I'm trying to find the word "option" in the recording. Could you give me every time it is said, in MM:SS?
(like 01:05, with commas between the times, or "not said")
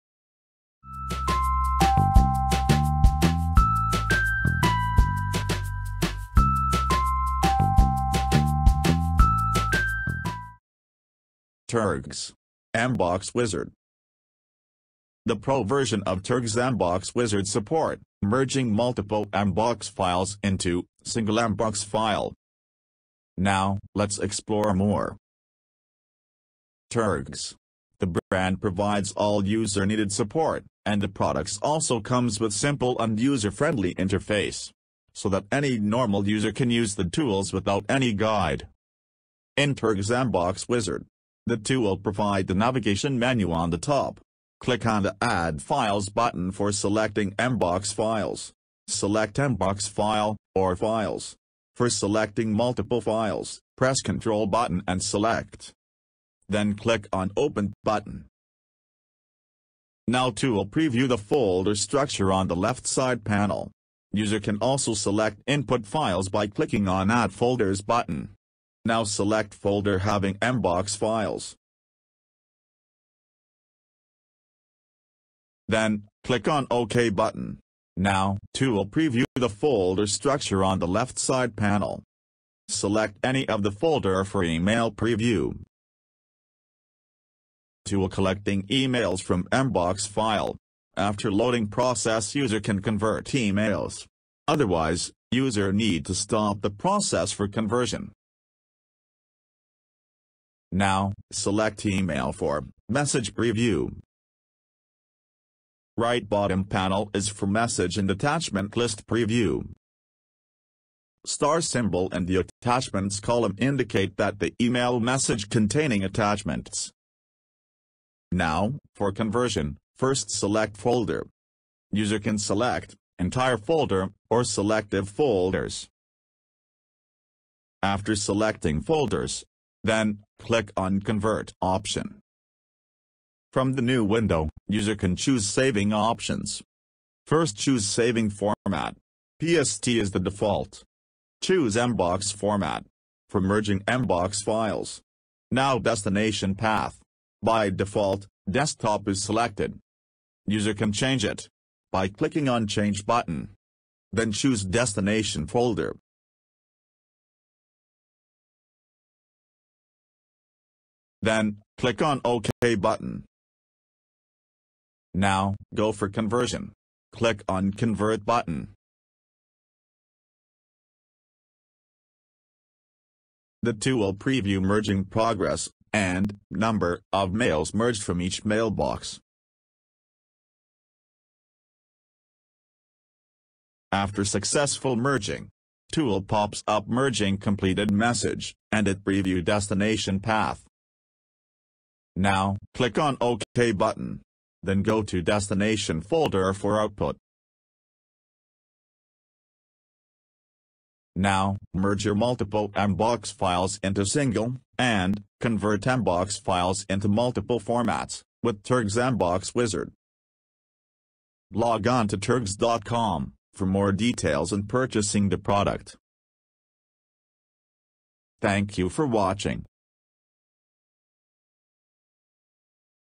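02:11, 02:15.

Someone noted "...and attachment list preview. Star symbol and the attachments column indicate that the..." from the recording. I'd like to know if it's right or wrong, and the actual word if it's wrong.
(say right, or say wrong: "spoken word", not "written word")
right.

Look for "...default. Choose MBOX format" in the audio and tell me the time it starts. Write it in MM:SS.
02:20.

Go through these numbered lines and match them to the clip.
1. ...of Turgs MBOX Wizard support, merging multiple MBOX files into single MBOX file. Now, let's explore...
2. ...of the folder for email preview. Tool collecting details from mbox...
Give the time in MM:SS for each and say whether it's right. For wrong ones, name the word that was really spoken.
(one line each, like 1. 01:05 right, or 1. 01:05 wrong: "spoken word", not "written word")
1. 00:16 right
2. 01:23 wrong: "emails", not "details".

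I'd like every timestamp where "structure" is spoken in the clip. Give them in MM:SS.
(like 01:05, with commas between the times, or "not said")
01:01, 01:20.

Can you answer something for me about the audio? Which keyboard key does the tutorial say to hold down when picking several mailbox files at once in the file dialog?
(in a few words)
Control.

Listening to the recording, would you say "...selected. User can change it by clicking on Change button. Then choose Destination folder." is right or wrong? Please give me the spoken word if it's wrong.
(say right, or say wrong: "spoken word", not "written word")
right.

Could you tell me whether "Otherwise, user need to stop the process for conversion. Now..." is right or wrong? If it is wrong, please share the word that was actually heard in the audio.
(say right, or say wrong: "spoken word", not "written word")
right.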